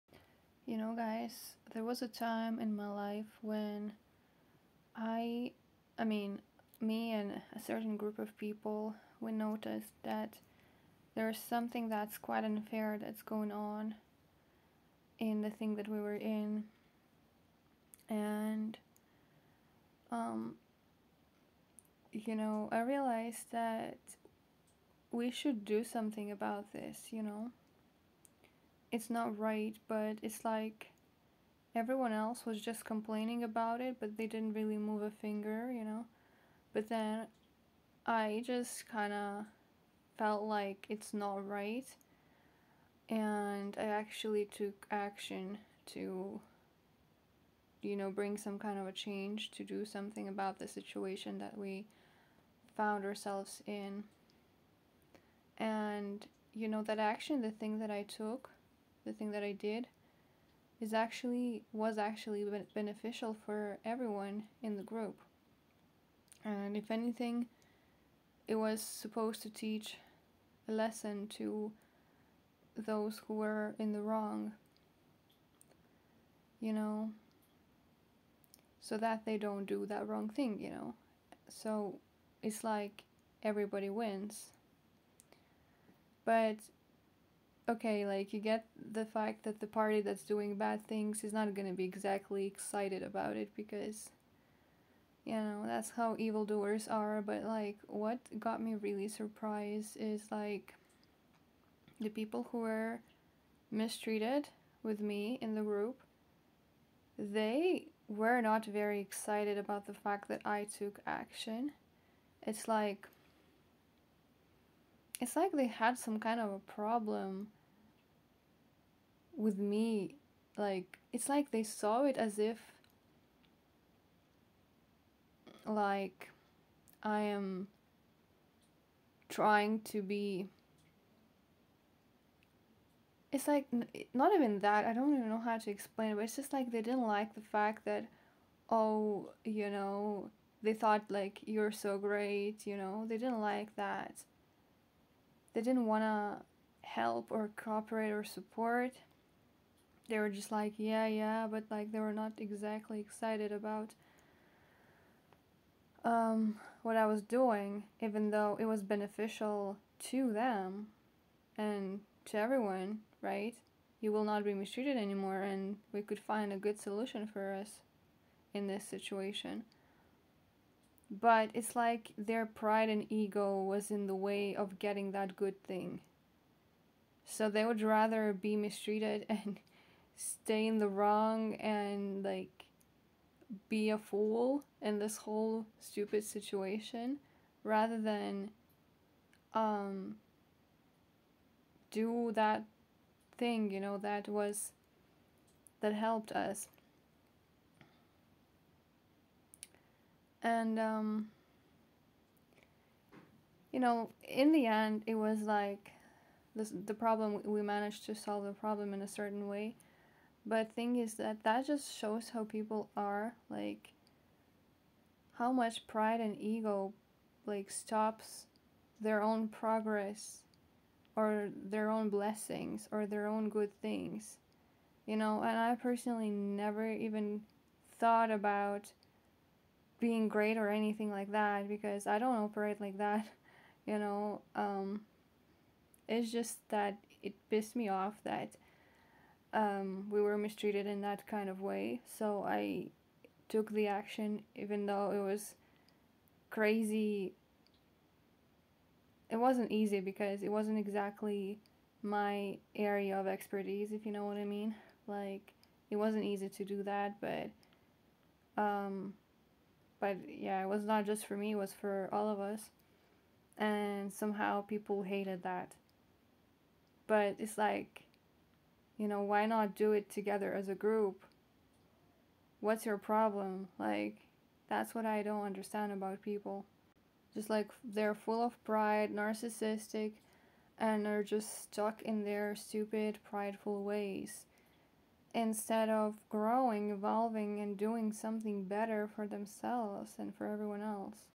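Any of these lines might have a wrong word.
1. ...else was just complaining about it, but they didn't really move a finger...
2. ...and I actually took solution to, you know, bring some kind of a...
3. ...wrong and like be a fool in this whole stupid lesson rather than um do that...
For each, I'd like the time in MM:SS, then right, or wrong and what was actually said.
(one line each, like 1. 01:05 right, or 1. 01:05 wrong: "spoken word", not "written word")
1. 00:32 right
2. 00:43 wrong: "action", not "solution"
3. 03:00 wrong: "situation", not "lesson".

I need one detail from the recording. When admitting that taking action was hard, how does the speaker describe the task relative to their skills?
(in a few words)
my area of expertise.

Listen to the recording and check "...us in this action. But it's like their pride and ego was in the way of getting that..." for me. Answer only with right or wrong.
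wrong.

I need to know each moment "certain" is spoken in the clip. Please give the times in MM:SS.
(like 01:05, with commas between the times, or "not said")
00:07, 03:29.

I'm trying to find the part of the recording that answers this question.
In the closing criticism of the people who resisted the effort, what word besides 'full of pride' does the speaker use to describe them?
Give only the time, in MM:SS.
04:39.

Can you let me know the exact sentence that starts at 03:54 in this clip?
Um, it's just that it pissed me off that um, we were mistreated in that kind of way.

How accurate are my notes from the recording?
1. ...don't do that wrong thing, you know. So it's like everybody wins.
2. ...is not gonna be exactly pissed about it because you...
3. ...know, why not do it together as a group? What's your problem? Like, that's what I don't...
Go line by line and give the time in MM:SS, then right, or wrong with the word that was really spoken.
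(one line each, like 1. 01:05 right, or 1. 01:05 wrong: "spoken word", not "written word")
1. 01:19 right
2. 01:31 wrong: "excited", not "pissed"
3. 04:29 right.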